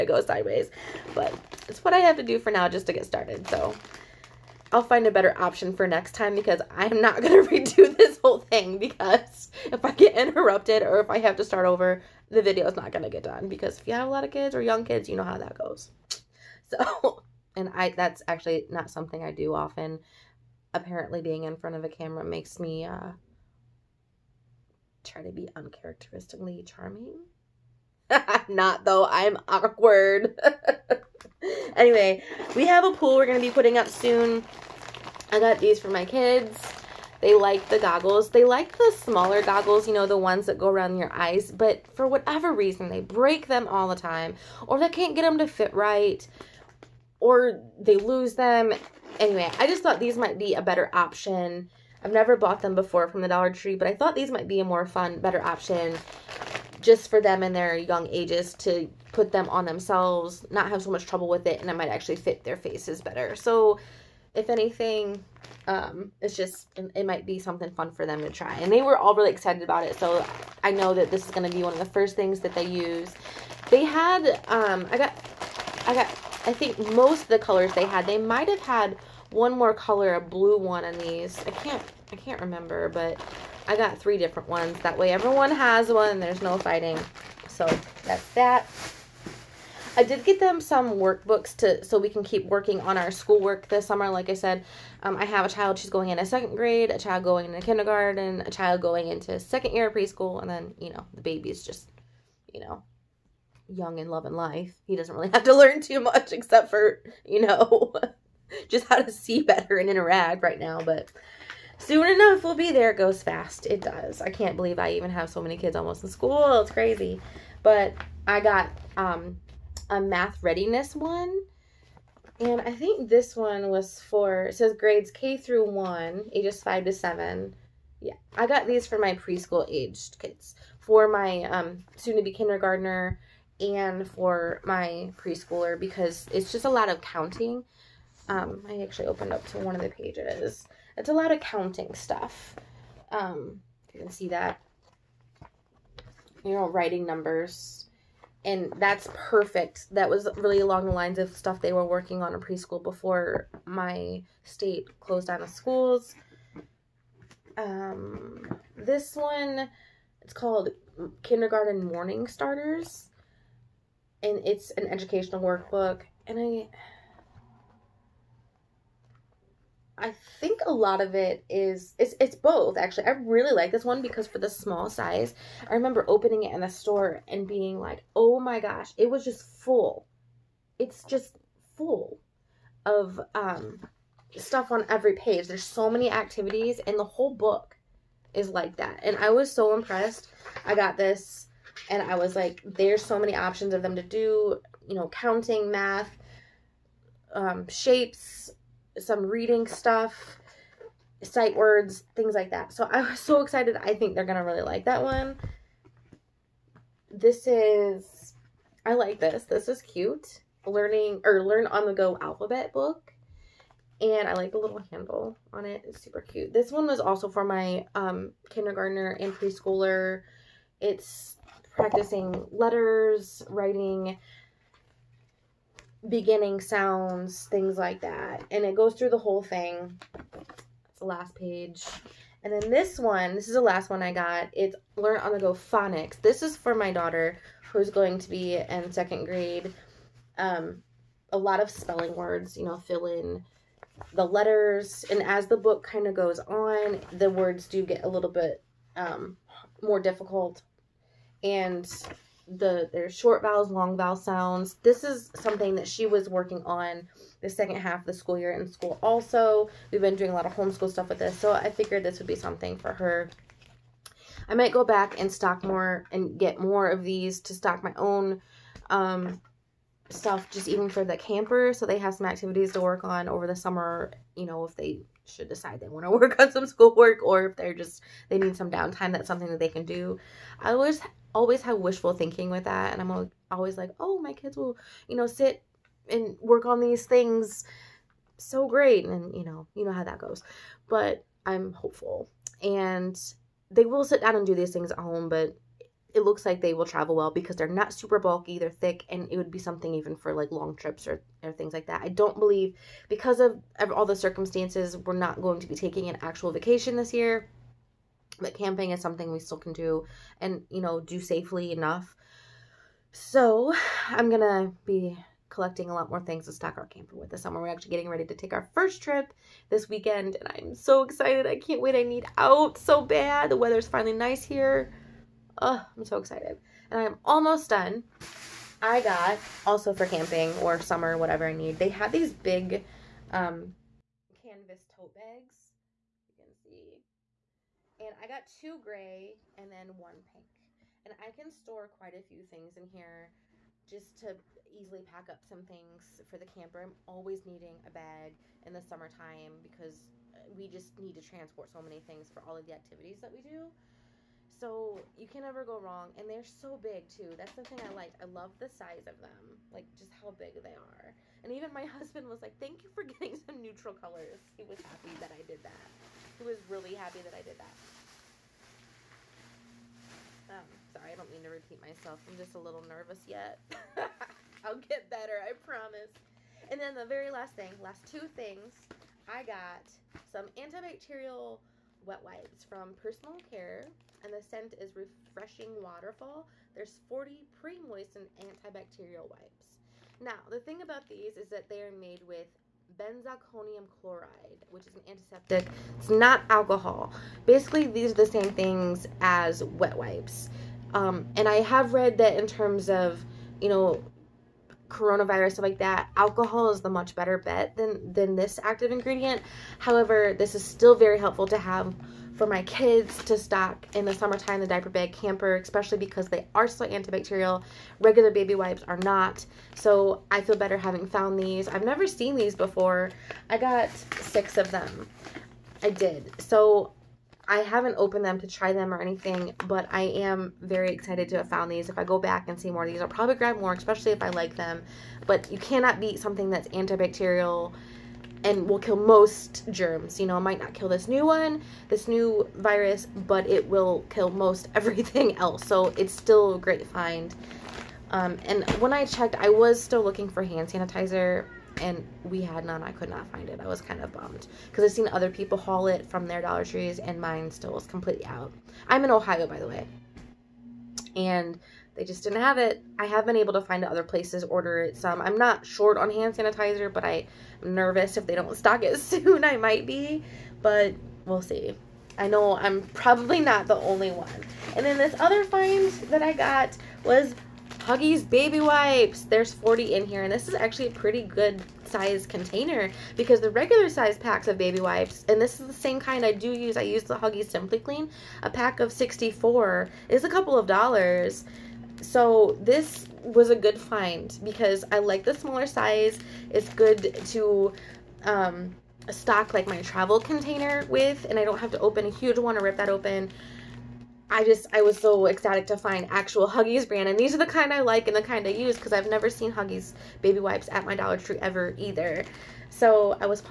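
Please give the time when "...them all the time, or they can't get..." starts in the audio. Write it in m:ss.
0:43.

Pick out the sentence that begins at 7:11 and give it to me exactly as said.
If I go back and see more of these, I'll probably grab more, especially if I like them.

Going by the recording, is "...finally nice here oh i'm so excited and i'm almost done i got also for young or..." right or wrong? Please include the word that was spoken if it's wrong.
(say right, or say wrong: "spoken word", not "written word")
wrong: "camping", not "young".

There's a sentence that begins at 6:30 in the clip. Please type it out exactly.
Now, the thing about these is that they are made with benzalkonium chloride, which is an antiseptic.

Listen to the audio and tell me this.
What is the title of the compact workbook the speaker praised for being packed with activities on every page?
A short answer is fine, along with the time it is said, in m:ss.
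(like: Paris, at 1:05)
Kindergarten Morning Starters, at 2:41.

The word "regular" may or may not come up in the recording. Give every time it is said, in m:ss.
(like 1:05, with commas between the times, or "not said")
6:57, 8:03.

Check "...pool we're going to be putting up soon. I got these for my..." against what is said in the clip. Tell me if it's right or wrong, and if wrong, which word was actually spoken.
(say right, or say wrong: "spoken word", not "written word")
right.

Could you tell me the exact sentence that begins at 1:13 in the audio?
They had um, I got I got I think most of the colors they had.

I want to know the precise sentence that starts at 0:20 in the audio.
Apparently, being in front of a camera makes me uh, try to be uncharacteristically charming.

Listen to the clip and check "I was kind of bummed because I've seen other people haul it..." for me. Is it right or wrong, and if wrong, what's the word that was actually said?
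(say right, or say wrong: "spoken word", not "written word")
right.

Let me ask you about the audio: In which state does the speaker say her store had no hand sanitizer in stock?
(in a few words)
Ohio.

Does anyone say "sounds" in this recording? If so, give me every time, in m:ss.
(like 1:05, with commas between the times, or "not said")
3:46, 4:14.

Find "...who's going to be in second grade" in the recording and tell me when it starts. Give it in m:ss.
3:57.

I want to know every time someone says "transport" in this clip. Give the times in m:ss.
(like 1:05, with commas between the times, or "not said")
5:51.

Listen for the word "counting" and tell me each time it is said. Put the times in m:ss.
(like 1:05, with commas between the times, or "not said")
2:16, 2:21, 3:15.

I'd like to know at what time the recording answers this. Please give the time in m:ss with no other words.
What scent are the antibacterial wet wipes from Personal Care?
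6:24.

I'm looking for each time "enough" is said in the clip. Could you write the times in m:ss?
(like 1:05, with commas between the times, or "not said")
1:52, 5:11.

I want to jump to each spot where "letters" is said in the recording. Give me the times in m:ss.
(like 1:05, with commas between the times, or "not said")
3:42, 4:04.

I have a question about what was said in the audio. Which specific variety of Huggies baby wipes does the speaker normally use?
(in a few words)
Simply Clean.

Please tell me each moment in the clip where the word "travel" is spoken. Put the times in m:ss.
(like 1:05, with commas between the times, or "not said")
4:56, 8:19.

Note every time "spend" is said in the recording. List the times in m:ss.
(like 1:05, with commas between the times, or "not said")
not said.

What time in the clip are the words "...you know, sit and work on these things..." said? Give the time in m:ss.
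4:45.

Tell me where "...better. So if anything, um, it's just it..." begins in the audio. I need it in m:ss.
1:02.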